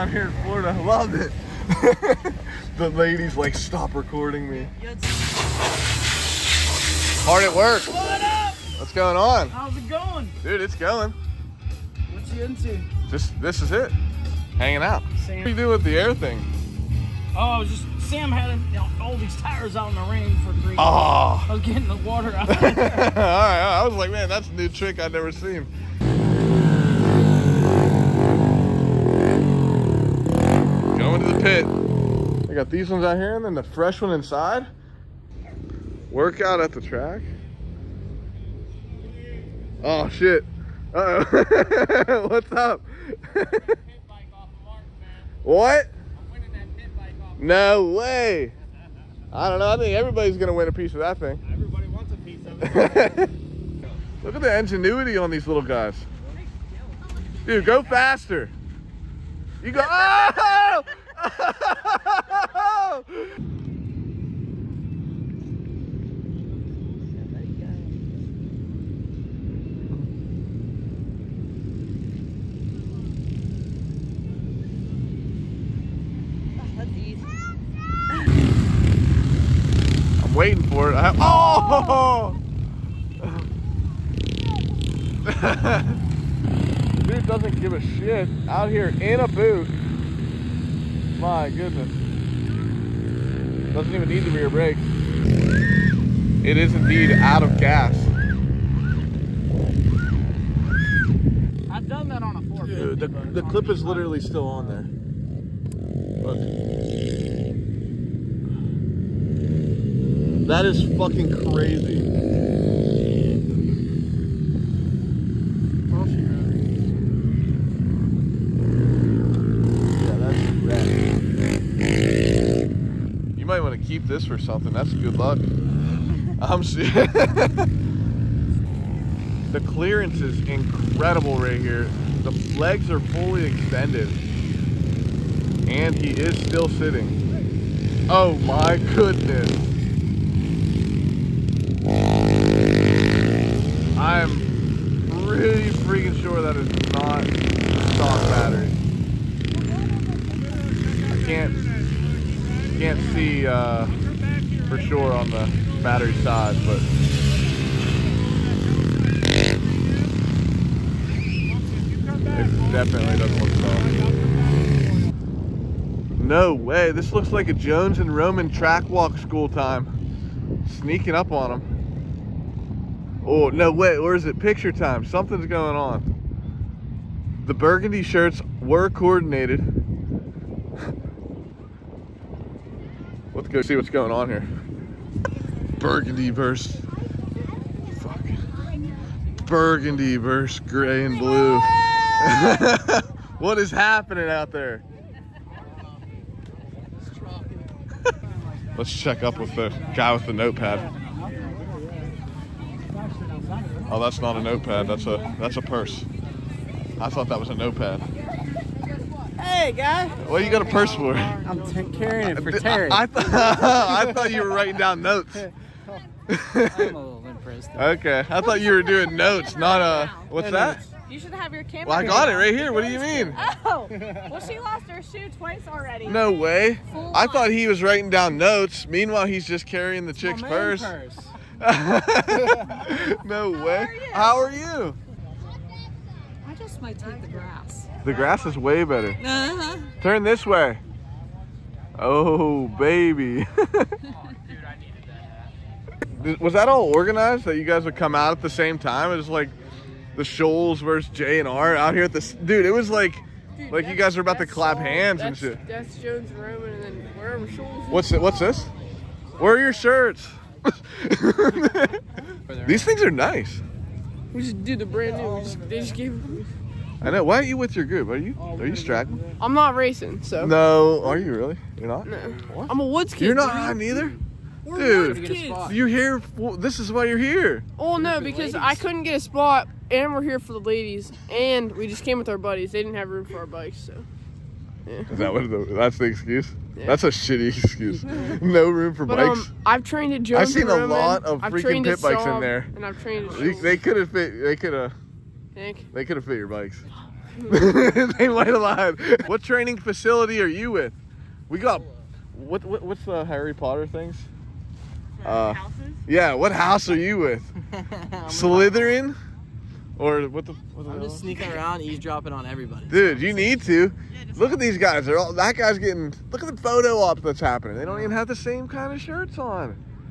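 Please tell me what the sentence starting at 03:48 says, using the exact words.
Meanwhile, he's just carrying the it's chick's purse.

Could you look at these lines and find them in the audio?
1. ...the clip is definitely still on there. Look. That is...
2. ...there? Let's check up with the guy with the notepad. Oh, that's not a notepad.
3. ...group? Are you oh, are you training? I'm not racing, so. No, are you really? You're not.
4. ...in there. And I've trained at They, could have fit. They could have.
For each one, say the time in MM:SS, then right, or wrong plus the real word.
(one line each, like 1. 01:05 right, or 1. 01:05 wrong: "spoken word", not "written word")
1. 01:43 wrong: "literally", not "definitely"
2. 03:14 right
3. 04:27 wrong: "straggling", not "training"
4. 04:52 right.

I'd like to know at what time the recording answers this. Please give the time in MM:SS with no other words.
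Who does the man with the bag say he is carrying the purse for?
03:32.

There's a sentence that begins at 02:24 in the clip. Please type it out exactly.
I am pretty freaking sure that is not stock battery.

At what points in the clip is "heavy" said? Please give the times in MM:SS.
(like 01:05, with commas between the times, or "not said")
not said.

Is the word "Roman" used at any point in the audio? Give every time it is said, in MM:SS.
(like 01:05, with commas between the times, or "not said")
02:48, 04:16.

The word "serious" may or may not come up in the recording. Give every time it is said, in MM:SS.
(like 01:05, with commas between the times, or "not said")
02:06.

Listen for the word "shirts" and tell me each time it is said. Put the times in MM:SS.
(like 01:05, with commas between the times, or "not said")
02:58, 04:19, 05:18.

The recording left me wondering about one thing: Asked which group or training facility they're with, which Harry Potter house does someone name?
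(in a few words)
Slytherin.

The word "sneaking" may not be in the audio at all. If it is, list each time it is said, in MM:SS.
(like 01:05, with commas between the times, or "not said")
02:50, 05:11.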